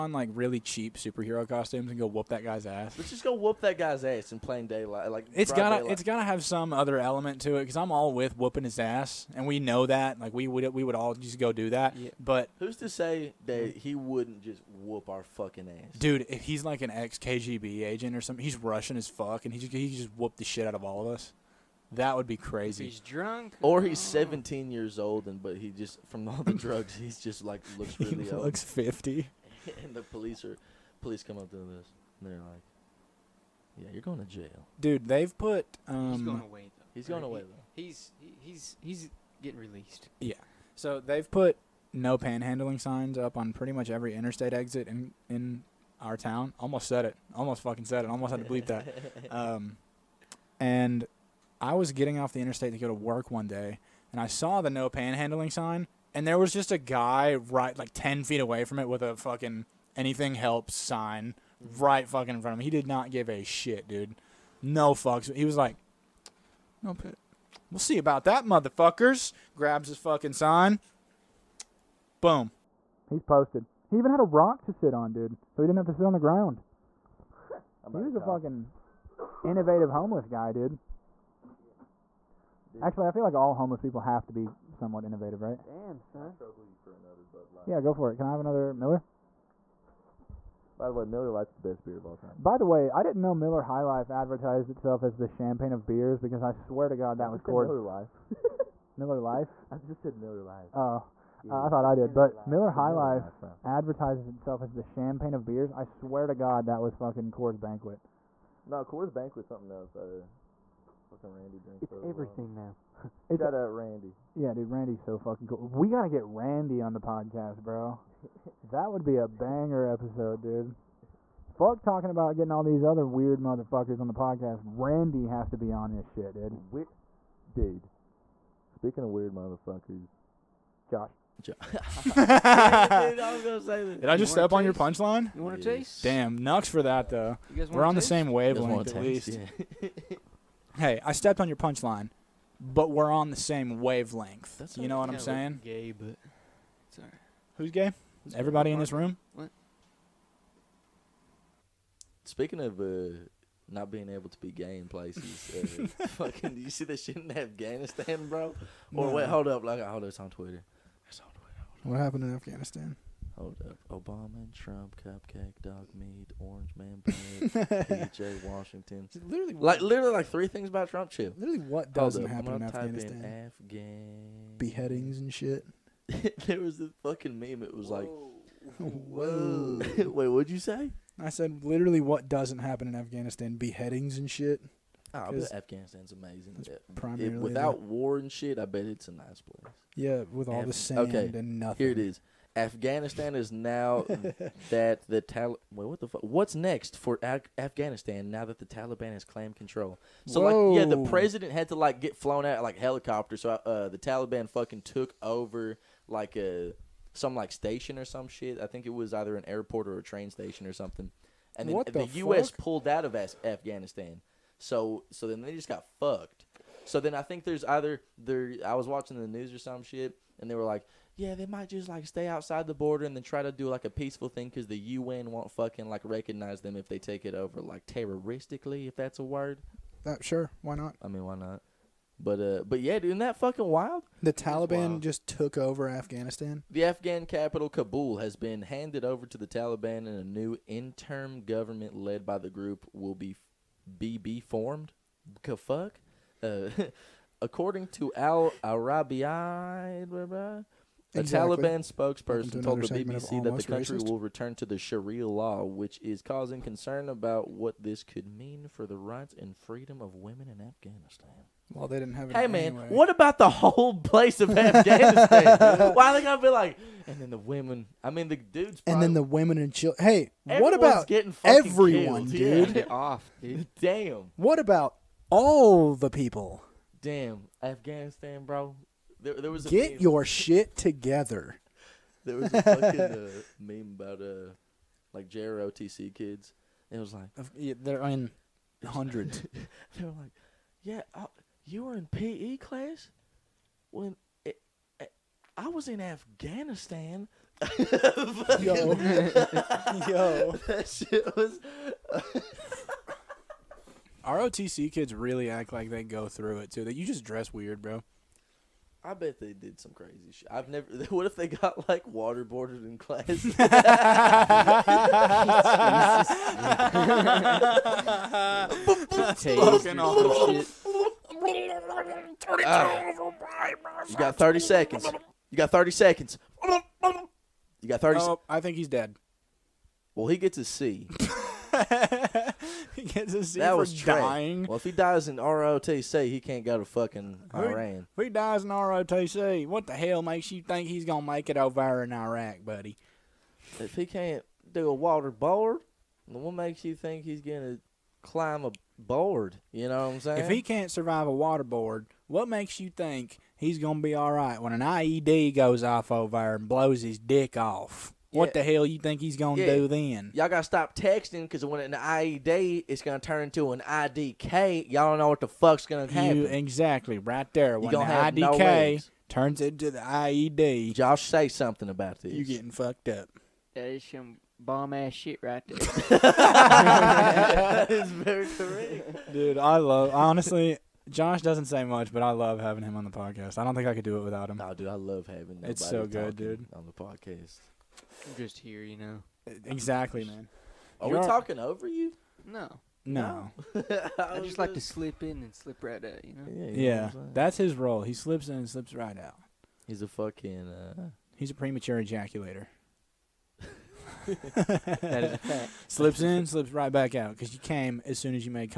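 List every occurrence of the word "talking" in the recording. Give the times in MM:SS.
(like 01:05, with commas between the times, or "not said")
02:01, 06:31.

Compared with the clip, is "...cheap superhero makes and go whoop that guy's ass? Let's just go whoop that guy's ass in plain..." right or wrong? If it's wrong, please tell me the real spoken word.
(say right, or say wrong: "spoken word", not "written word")
wrong: "costumes", not "makes".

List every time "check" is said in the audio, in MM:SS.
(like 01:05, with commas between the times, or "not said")
not said.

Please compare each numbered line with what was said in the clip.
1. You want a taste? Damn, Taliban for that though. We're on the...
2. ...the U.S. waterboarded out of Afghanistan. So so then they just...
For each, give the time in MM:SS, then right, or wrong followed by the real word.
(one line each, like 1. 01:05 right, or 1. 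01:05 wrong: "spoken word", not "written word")
1. 02:15 wrong: "Nux", not "Taliban"
2. 03:31 wrong: "pulled", not "waterboarded".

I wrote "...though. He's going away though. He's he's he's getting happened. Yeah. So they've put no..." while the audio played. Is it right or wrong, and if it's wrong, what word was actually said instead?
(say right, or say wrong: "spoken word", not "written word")
wrong: "released", not "happened".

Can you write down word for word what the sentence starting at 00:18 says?
He's Russian as fuck, and he just, he just whooped the shit out of all of us.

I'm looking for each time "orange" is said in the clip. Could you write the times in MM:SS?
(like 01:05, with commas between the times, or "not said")
02:46.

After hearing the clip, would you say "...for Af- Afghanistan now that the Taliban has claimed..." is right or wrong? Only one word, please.
right.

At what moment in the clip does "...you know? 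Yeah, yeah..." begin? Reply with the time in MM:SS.
06:36.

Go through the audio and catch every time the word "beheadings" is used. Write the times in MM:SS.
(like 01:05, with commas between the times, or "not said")
02:54, 03:03.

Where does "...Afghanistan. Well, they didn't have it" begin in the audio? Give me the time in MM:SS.
04:20.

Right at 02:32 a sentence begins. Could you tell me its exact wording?
Speaking of uh, not being able to be gay in places, uh, fucking, do you see that shit in Afghanistan, bro?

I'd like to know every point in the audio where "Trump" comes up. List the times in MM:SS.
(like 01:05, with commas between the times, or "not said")
02:44, 02:50.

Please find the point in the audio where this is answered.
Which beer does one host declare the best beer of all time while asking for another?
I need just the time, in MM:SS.
01:31.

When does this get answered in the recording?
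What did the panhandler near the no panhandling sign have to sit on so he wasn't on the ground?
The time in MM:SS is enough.
01:14.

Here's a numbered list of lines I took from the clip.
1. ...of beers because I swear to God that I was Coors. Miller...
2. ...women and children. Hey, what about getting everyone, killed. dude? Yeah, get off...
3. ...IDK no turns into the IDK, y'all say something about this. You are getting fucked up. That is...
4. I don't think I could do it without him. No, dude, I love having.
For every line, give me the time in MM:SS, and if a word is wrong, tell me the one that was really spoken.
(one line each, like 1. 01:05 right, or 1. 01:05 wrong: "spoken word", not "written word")
1. 01:35 right
2. 04:29 right
3. 06:08 wrong: "IED", not "IDK"
4. 06:23 right.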